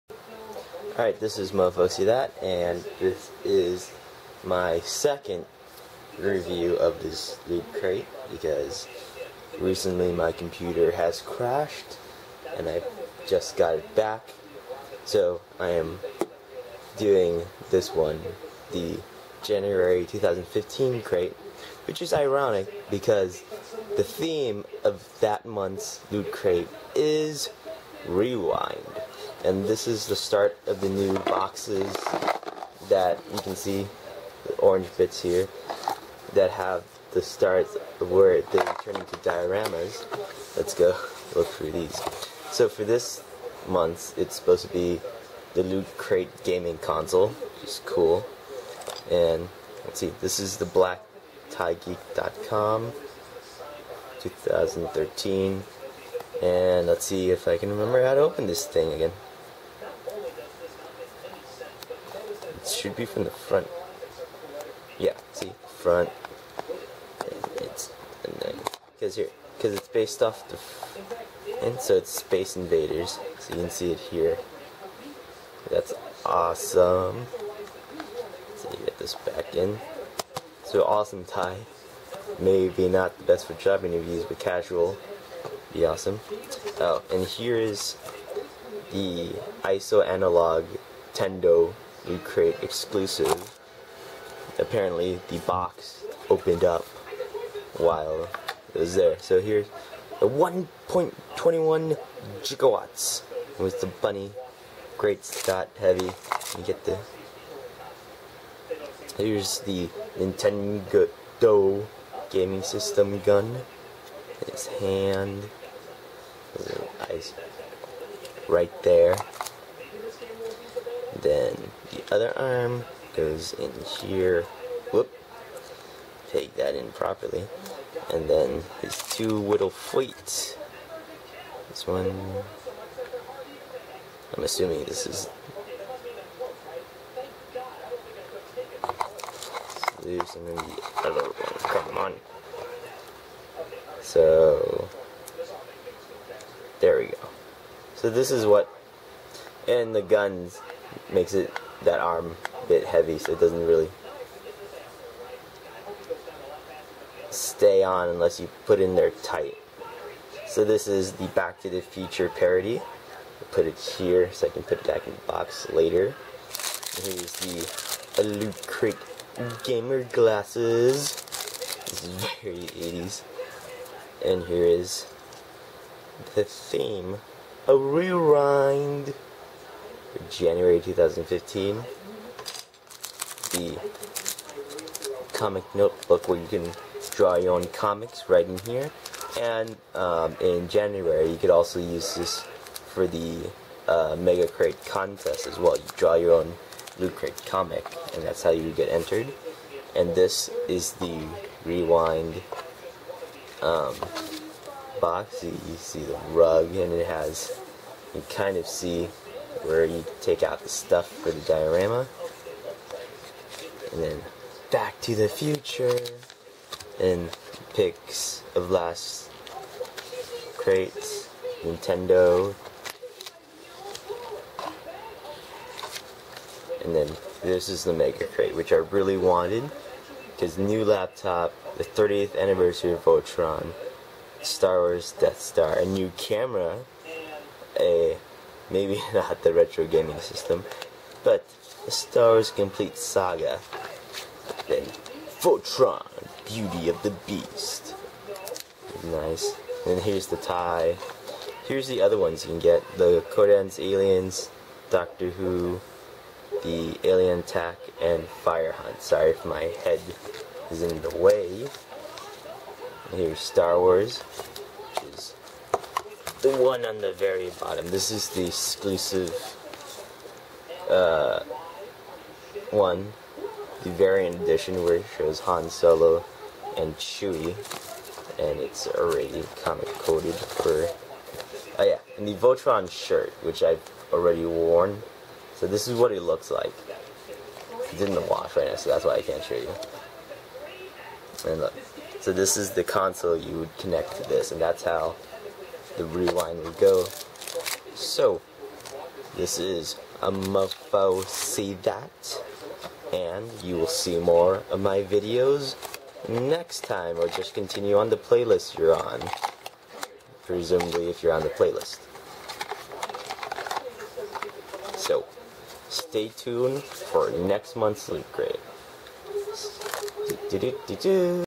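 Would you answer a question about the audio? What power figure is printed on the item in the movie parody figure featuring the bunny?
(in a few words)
1.21 gigawatts.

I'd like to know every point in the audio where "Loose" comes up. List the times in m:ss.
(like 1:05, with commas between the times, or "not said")
2:20.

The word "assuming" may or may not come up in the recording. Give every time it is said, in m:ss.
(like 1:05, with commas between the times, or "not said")
2:14.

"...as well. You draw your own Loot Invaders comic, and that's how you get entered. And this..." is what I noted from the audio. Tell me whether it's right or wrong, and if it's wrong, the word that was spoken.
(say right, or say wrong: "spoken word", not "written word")
wrong: "Crate", not "Invaders".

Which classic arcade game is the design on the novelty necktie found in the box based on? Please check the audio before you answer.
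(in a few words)
Space Invaders.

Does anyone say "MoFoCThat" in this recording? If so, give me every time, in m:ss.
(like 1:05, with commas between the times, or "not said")
0:01, 5:00.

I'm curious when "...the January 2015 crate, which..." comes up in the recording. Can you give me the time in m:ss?
0:18.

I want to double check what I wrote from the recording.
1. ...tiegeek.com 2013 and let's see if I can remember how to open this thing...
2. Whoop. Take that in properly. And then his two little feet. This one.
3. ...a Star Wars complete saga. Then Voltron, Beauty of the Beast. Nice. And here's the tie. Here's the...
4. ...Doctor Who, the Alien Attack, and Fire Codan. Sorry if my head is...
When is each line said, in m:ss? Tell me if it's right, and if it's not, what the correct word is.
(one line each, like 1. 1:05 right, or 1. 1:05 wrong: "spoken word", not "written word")
1. 0:51 right
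2. 2:04 right
3. 4:01 right
4. 4:14 wrong: "Hunt", not "Codan".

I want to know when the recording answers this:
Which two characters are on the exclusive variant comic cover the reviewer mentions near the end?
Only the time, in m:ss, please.
4:35.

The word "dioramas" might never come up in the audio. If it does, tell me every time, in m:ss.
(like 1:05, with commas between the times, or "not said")
0:39, 3:31.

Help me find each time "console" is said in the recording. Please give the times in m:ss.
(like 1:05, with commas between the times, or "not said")
0:46, 4:52.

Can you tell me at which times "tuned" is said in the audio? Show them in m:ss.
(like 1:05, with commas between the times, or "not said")
5:16.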